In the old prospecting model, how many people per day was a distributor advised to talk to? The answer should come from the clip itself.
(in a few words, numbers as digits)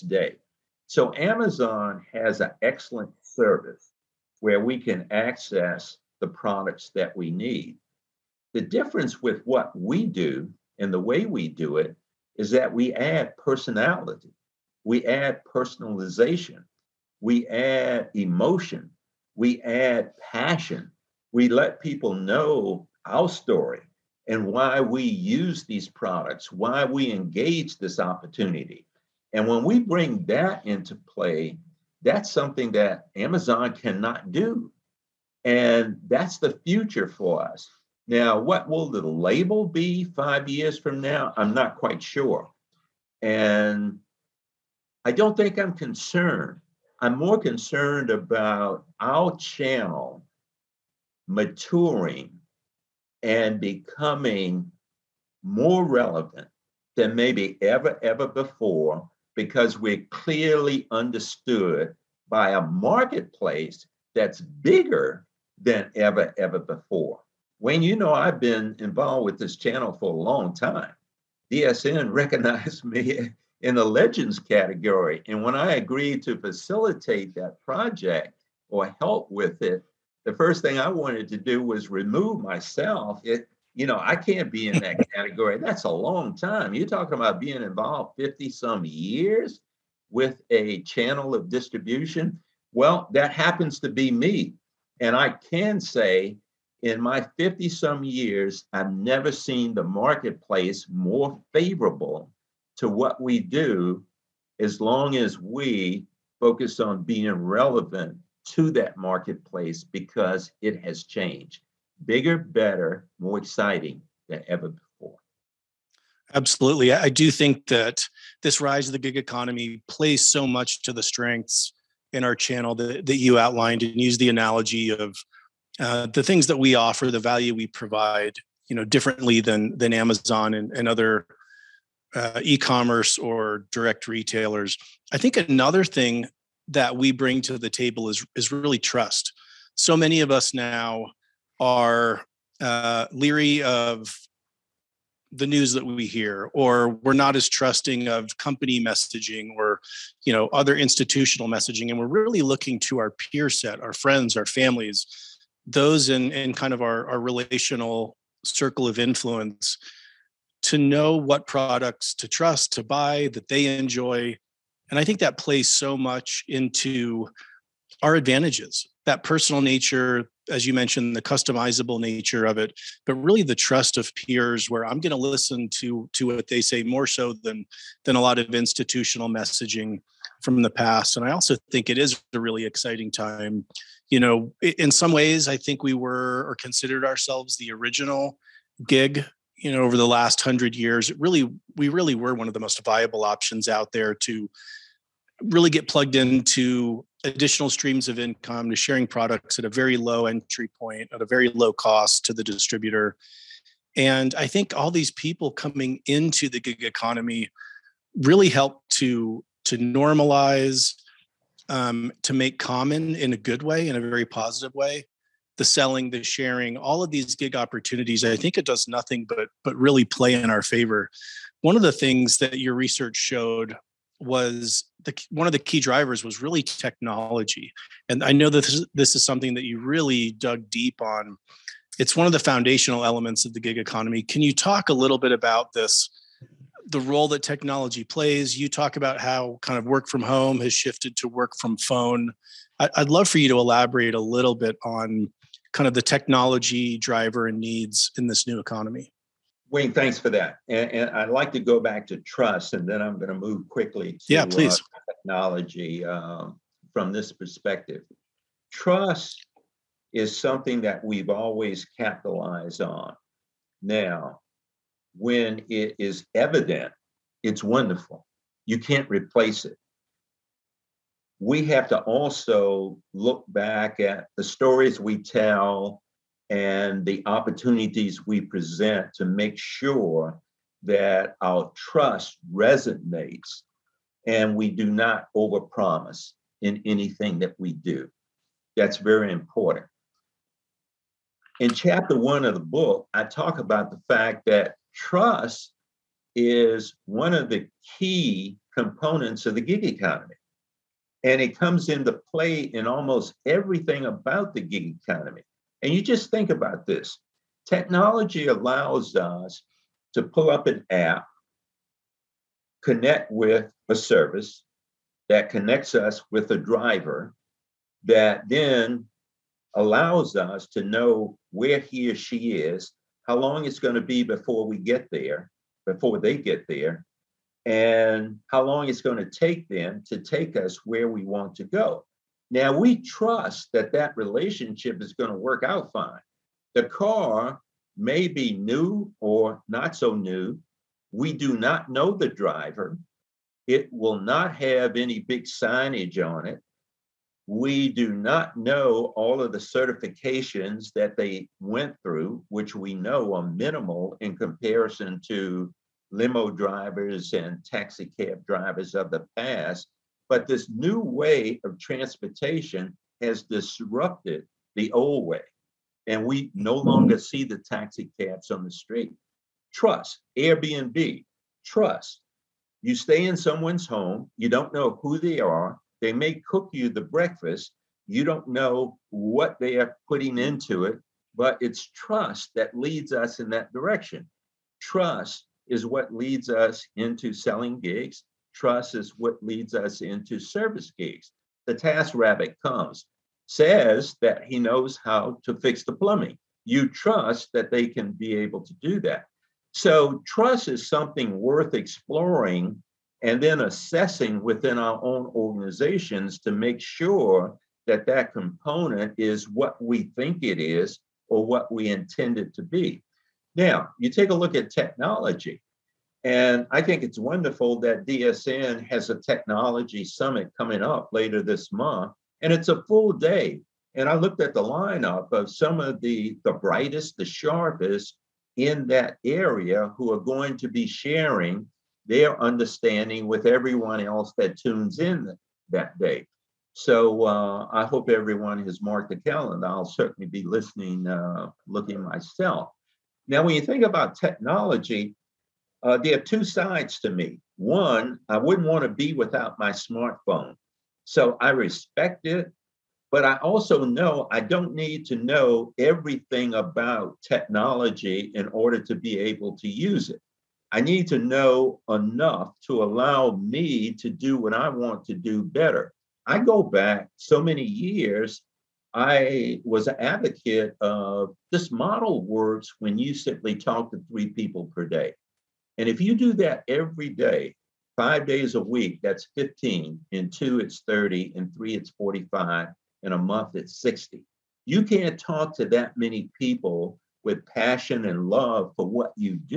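3.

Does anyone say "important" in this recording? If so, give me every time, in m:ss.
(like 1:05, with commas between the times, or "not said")
4:49.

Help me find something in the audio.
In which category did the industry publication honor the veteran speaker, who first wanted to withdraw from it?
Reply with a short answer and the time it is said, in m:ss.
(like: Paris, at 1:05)
legends, at 1:13.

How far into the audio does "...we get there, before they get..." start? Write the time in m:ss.
5:24.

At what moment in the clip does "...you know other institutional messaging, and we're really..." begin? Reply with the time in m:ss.
2:30.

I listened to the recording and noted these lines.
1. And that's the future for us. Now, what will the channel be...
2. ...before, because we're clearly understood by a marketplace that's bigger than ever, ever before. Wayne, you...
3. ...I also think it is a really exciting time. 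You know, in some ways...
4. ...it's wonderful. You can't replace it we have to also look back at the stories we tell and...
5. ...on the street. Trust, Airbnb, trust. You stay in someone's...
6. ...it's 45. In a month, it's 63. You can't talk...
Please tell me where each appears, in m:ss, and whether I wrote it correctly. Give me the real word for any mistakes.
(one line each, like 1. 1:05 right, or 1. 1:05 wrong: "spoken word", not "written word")
1. 0:35 wrong: "label", not "channel"
2. 0:58 right
3. 3:01 right
4. 4:27 right
5. 6:08 right
6. 8:01 wrong: "60", not "63".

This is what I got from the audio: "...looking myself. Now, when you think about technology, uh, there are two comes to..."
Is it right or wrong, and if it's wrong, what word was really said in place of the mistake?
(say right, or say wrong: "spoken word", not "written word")
wrong: "sides", not "comes".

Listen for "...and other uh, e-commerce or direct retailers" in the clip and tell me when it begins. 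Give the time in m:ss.
2:10.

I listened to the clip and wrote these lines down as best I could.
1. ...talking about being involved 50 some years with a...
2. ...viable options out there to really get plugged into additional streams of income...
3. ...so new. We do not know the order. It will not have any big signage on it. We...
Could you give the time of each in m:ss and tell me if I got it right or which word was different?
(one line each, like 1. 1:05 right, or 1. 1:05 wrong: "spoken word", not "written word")
1. 1:26 right
2. 3:12 right
3. 5:39 wrong: "driver", not "order".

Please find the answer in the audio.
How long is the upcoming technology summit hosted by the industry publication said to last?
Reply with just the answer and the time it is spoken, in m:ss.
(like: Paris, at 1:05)
a full day, at 7:02.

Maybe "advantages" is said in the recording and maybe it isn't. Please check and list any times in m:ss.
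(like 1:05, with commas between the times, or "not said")
2:48.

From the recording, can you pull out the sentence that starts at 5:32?
Now, we trust that that relationship is going to work out fine.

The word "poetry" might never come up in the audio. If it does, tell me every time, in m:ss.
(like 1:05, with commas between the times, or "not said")
not said.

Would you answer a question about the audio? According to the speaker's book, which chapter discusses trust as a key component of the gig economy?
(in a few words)
chapter one.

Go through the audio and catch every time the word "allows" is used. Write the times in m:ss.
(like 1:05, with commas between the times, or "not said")
5:08, 5:19, 7:42.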